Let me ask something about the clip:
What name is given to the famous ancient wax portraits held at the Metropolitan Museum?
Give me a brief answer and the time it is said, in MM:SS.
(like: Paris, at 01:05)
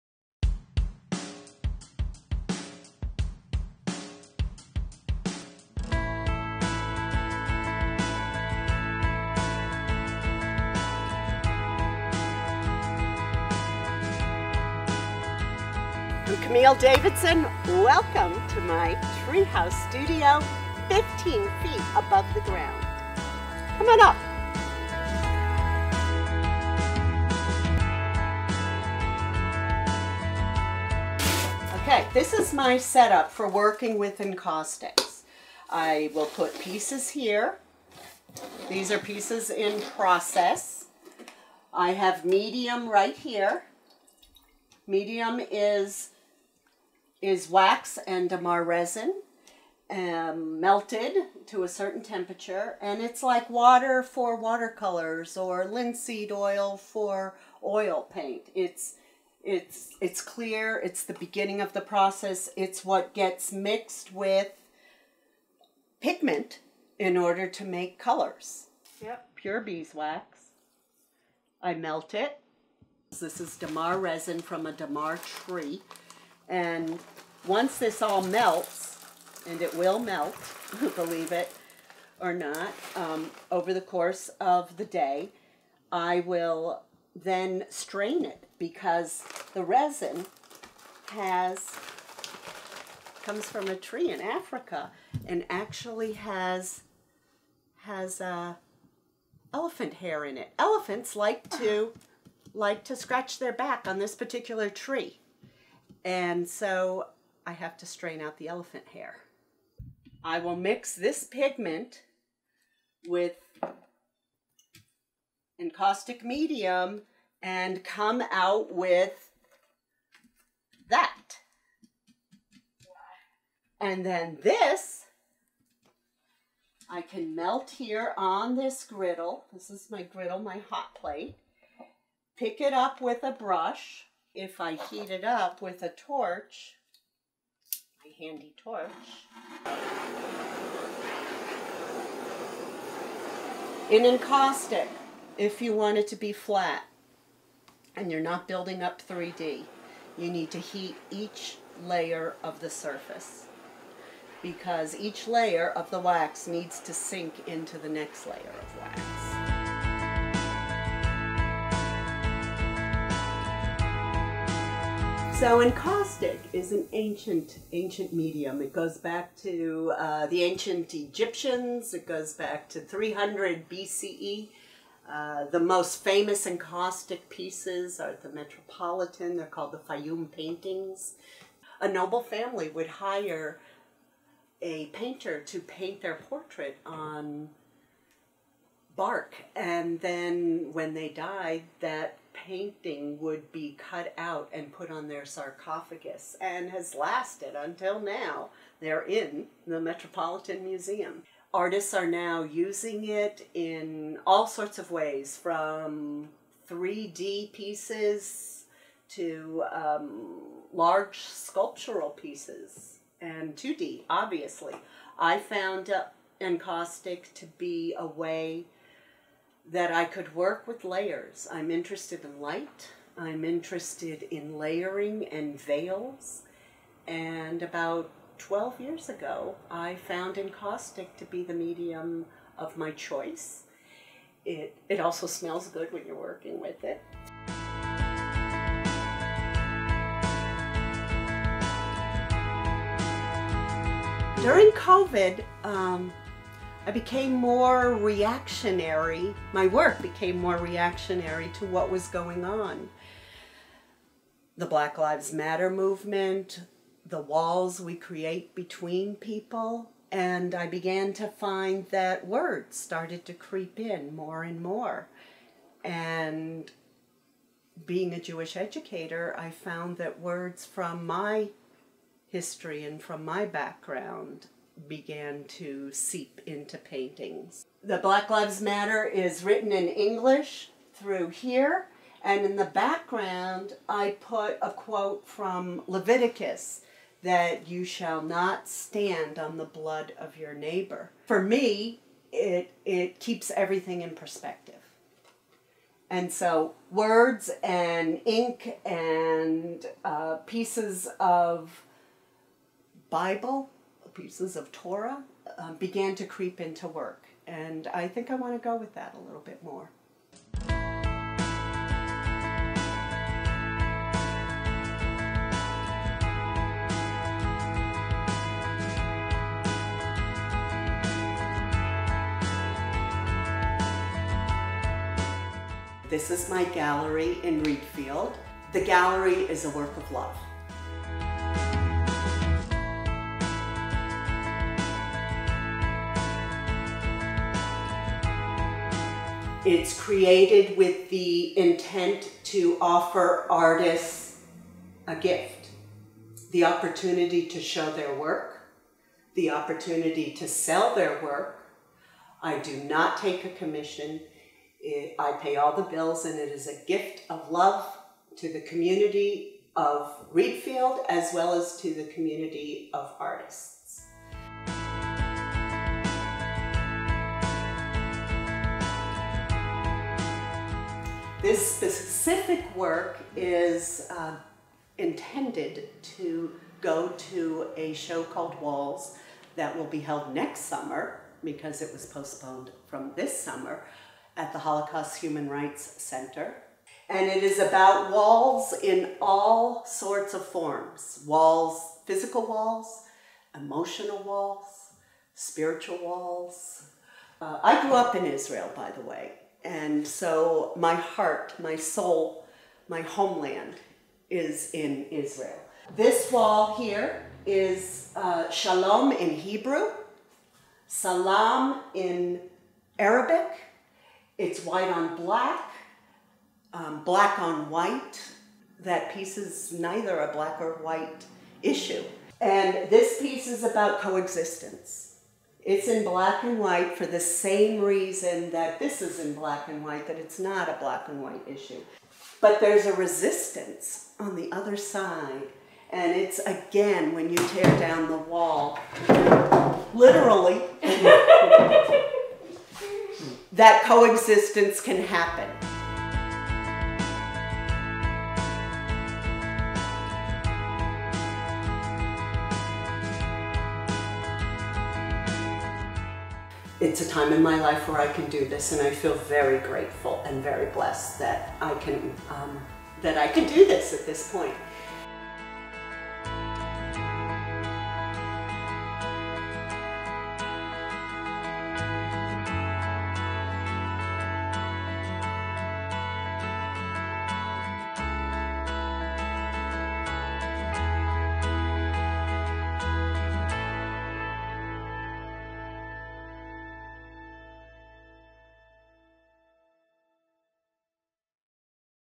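Fayum paintings, at 02:59.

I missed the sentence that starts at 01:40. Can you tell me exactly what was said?
Elephants like to like to scratch their back on this particular tree.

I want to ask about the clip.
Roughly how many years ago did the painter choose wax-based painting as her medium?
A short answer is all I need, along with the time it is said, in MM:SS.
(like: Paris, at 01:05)
12, at 03:48.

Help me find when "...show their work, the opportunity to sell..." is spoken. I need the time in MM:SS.
05:47.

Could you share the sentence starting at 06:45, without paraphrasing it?
This wall here is uh, shalom in Hebrew, salam in Arabic.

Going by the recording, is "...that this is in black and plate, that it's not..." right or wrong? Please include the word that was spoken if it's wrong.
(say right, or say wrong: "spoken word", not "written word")
wrong: "white", not "plate".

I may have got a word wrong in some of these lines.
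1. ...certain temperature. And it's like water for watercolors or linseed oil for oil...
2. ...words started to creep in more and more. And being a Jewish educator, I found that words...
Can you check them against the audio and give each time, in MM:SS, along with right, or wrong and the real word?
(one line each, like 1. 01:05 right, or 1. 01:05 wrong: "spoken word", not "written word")
1. 00:51 right
2. 04:22 right.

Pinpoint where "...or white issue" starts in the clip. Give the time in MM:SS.
07:00.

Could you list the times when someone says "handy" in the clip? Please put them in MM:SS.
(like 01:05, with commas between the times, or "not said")
02:18.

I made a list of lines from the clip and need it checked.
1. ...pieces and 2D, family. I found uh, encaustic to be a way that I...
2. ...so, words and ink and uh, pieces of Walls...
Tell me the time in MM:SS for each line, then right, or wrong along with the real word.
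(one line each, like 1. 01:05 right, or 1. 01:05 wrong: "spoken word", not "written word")
1. 03:32 wrong: "obviously", not "family"
2. 04:56 wrong: "Bible", not "Walls".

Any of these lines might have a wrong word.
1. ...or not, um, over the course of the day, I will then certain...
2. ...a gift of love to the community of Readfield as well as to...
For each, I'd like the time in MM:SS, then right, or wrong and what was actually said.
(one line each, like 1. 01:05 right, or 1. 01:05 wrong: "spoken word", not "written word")
1. 01:22 wrong: "strain", not "certain"
2. 05:56 right.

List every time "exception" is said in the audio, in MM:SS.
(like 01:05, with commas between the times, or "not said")
not said.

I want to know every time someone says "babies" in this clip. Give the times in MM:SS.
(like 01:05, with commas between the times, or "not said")
not said.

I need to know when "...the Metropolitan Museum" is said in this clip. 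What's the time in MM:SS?
03:19.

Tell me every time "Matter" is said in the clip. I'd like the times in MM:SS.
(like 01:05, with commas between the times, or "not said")
04:15, 04:38.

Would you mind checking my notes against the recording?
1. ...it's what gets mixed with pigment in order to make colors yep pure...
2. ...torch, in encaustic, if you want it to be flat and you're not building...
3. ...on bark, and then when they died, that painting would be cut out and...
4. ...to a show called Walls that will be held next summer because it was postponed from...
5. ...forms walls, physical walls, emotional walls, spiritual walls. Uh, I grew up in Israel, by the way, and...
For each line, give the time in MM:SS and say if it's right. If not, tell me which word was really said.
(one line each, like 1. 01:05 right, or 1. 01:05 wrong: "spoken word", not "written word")
1. 01:02 right
2. 02:18 right
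3. 03:06 right
4. 06:17 right
5. 06:30 right.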